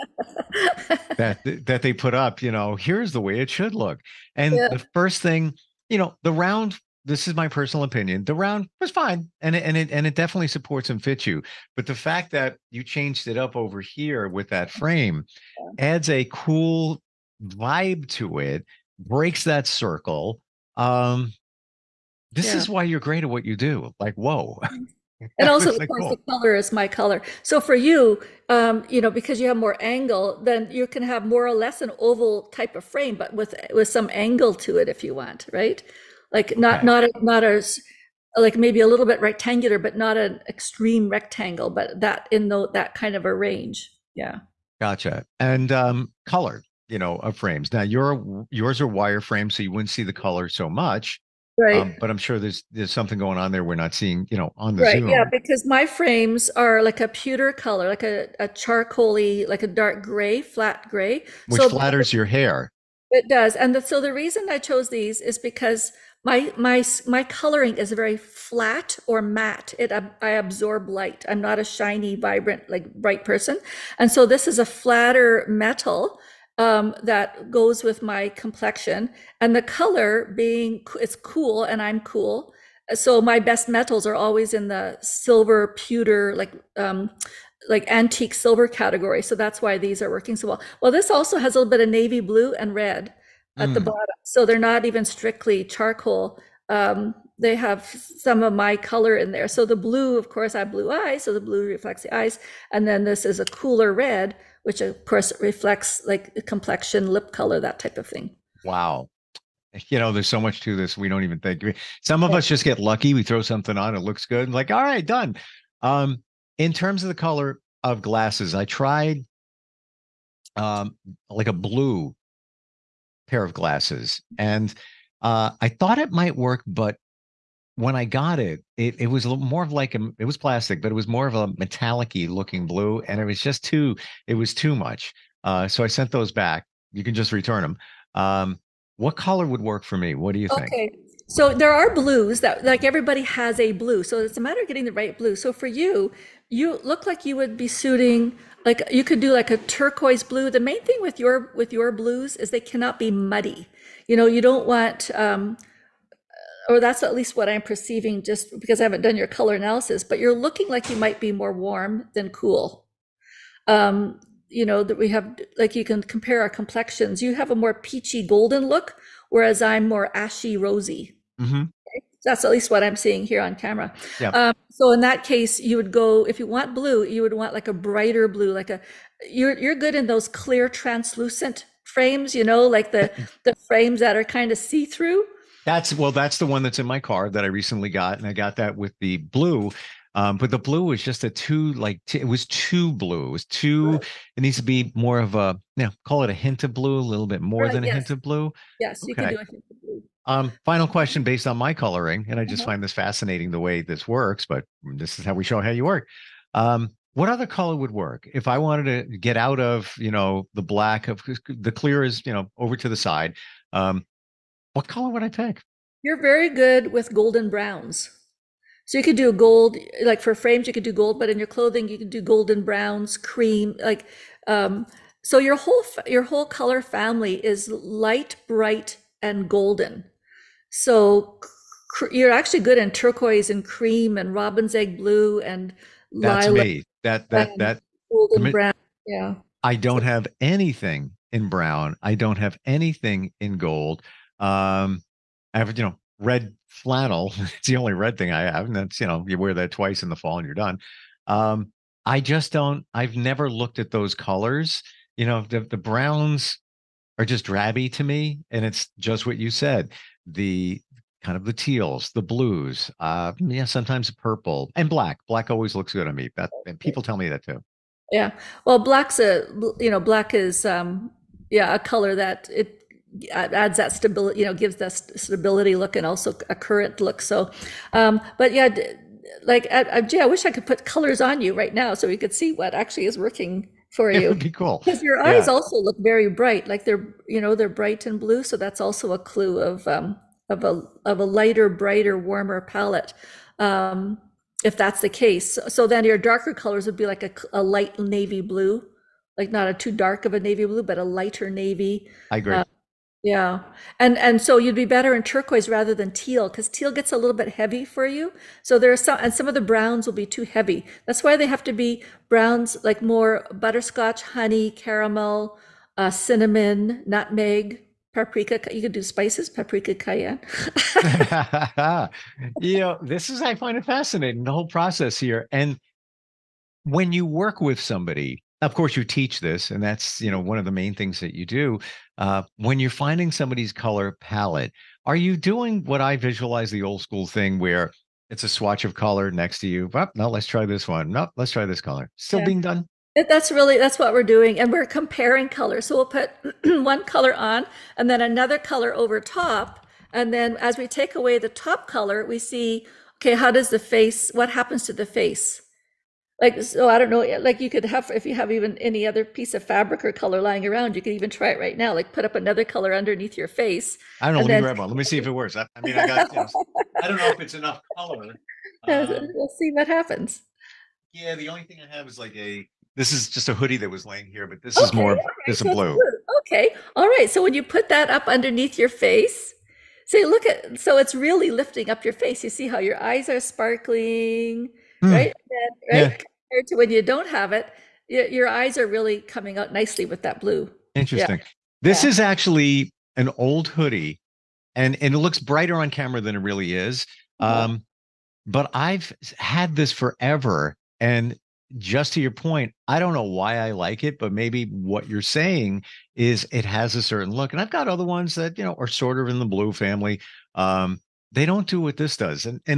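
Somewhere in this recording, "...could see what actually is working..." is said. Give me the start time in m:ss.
4:42.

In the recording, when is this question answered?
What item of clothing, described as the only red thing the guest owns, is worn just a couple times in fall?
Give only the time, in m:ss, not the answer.
4:06.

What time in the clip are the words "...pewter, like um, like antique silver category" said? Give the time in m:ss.
1:25.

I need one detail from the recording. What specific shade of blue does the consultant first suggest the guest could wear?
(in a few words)
turquoise blue.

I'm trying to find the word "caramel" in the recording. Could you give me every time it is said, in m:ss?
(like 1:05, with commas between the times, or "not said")
5:14.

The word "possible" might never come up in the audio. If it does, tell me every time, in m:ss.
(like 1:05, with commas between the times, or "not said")
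not said.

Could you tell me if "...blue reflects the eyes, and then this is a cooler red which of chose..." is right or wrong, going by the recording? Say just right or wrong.
wrong.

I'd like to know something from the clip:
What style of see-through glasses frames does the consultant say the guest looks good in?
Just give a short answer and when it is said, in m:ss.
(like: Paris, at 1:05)
clear translucent frames, at 3:00.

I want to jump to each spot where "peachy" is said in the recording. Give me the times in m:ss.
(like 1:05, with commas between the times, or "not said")
2:47.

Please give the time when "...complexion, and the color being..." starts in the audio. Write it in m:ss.
1:18.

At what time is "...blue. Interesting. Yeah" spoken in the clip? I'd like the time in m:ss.
6:30.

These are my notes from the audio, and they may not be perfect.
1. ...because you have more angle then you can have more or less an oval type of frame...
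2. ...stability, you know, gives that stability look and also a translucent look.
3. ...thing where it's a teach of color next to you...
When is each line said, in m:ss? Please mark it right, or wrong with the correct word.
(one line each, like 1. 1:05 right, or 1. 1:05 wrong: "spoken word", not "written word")
1. 0:29 right
2. 4:33 wrong: "current", not "translucent"
3. 5:37 wrong: "swatch", not "teach".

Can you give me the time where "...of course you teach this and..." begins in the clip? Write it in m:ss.
5:28.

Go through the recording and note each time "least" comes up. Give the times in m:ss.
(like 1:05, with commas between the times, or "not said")
2:37, 2:52.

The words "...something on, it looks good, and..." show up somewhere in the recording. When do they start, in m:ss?
1:53.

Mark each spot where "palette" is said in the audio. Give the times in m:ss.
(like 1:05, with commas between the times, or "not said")
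4:52, 5:34.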